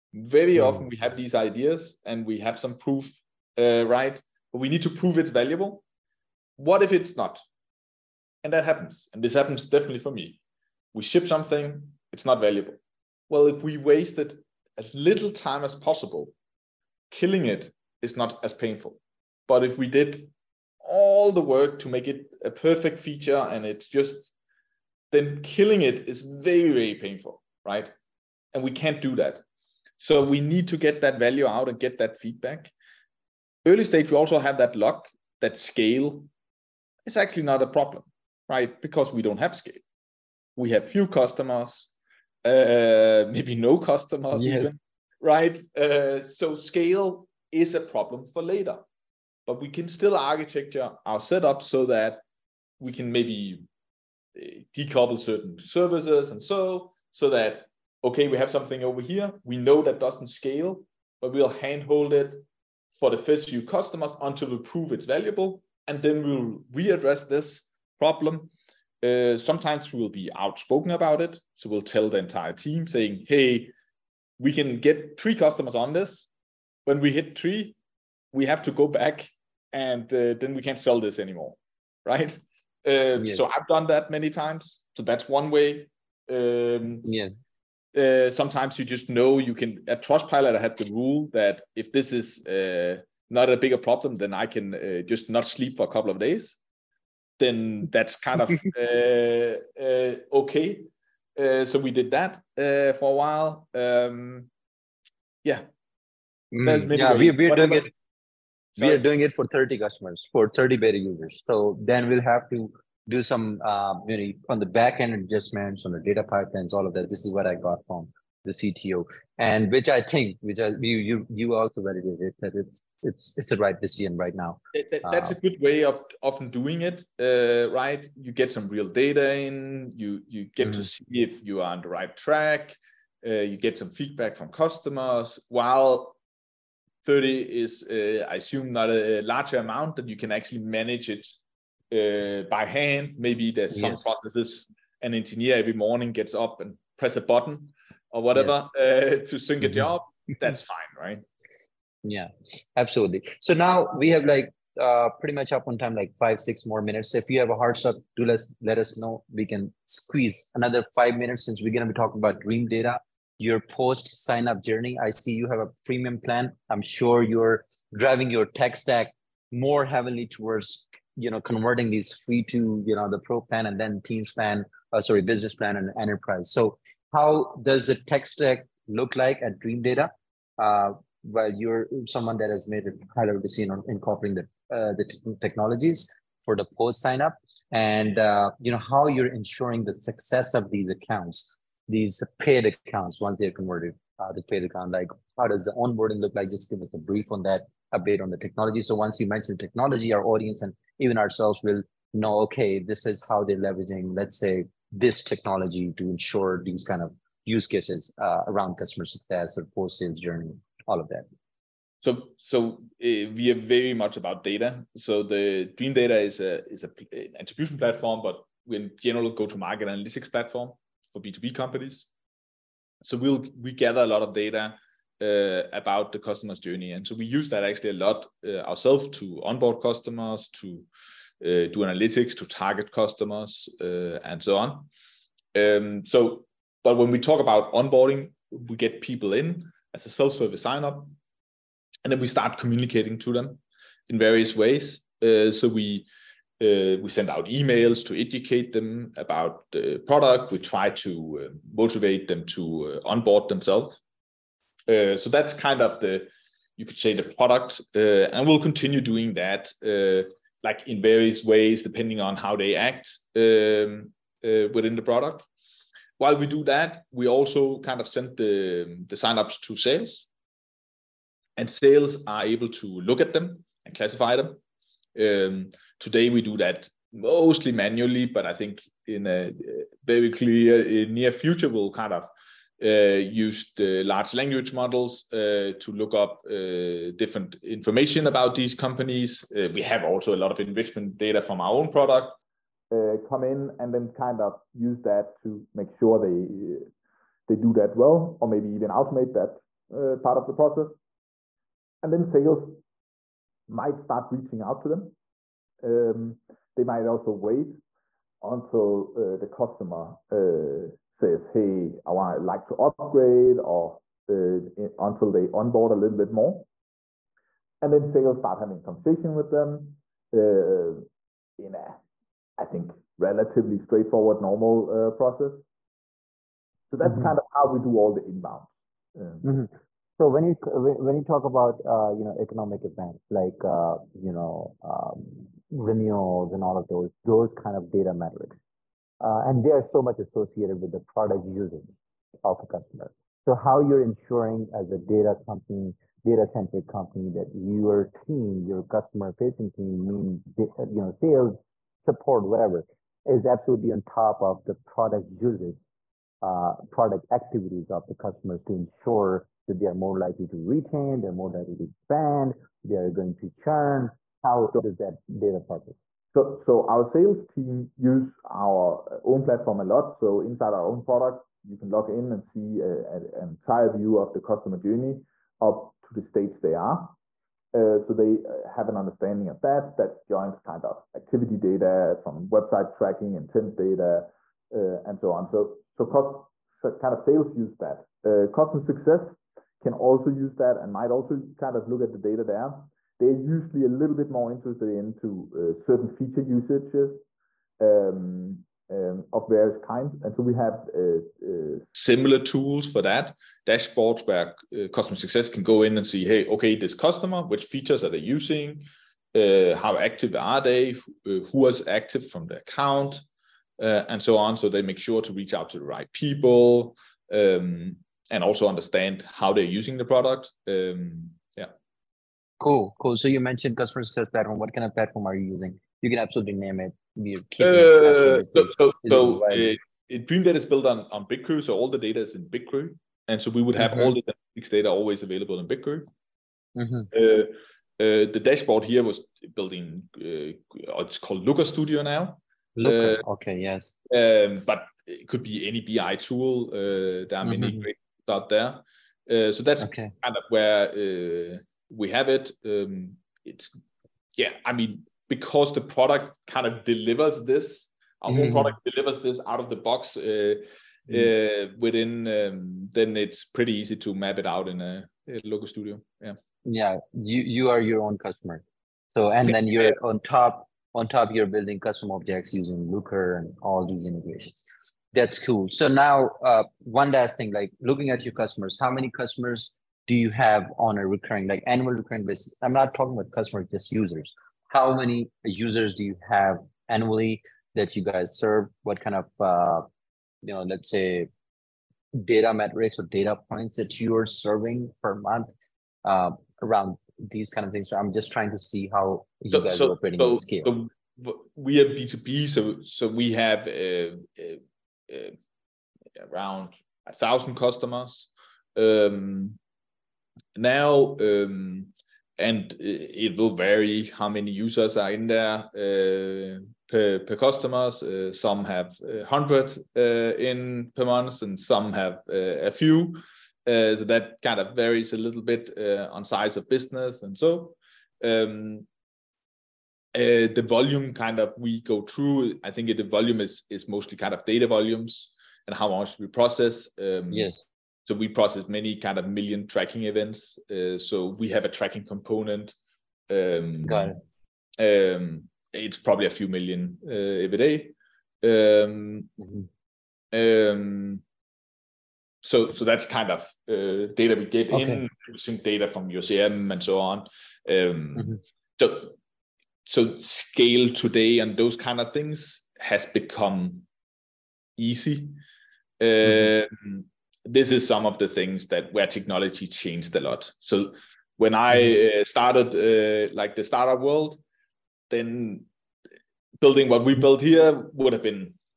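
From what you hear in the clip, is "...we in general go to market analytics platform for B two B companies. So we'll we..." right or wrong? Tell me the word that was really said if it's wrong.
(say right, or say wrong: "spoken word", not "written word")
right.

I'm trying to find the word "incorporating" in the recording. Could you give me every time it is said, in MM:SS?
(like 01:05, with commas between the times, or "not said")
03:03.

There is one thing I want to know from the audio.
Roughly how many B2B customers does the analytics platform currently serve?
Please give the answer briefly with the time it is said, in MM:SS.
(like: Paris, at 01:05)
1,000, at 08:27.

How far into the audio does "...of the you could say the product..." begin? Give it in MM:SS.
04:15.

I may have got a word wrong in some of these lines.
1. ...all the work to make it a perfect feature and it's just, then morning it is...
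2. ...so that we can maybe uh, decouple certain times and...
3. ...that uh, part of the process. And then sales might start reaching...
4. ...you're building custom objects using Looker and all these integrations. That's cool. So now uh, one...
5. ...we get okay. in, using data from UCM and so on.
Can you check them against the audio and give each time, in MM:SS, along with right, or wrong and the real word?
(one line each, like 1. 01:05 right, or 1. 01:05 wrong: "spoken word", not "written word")
1. 00:20 wrong: "killing", not "morning"
2. 00:51 wrong: "services", not "times"
3. 04:59 right
4. 07:51 right
5. 09:14 right.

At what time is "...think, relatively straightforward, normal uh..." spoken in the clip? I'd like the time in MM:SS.
05:22.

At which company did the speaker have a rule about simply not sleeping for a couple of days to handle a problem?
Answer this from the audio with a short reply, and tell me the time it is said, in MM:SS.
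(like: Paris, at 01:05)
Trustpilot, at 01:30.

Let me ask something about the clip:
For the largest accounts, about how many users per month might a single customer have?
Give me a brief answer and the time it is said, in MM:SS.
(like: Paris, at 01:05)
100, at 08:38.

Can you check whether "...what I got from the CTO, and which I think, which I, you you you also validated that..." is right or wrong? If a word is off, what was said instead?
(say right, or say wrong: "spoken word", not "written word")
right.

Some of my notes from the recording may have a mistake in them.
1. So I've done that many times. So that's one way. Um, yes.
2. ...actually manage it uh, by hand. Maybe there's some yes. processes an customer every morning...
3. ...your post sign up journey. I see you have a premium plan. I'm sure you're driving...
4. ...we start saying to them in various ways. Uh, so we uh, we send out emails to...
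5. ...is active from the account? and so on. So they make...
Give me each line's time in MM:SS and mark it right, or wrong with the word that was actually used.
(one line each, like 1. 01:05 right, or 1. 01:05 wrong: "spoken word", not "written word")
1. 01:23 right
2. 02:20 wrong: "engineer", not "customer"
3. 02:43 right
4. 04:02 wrong: "communicating", not "saying"
5. 06:51 right.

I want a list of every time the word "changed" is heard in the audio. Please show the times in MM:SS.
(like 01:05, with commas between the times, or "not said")
09:29.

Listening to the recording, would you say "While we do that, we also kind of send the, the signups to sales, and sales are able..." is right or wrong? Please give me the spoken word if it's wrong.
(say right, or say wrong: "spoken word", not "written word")
right.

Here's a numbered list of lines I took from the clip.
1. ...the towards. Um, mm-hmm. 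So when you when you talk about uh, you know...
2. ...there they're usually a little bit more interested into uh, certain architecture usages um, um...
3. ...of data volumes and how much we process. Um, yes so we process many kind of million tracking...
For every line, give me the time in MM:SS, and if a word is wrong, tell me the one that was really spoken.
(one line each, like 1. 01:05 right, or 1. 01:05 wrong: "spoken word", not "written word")
1. 05:28 wrong: "inbounds", not "towards"
2. 06:32 wrong: "feature", not "architecture"
3. 08:54 right.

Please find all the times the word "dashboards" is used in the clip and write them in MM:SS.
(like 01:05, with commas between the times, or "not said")
06:43, 07:18.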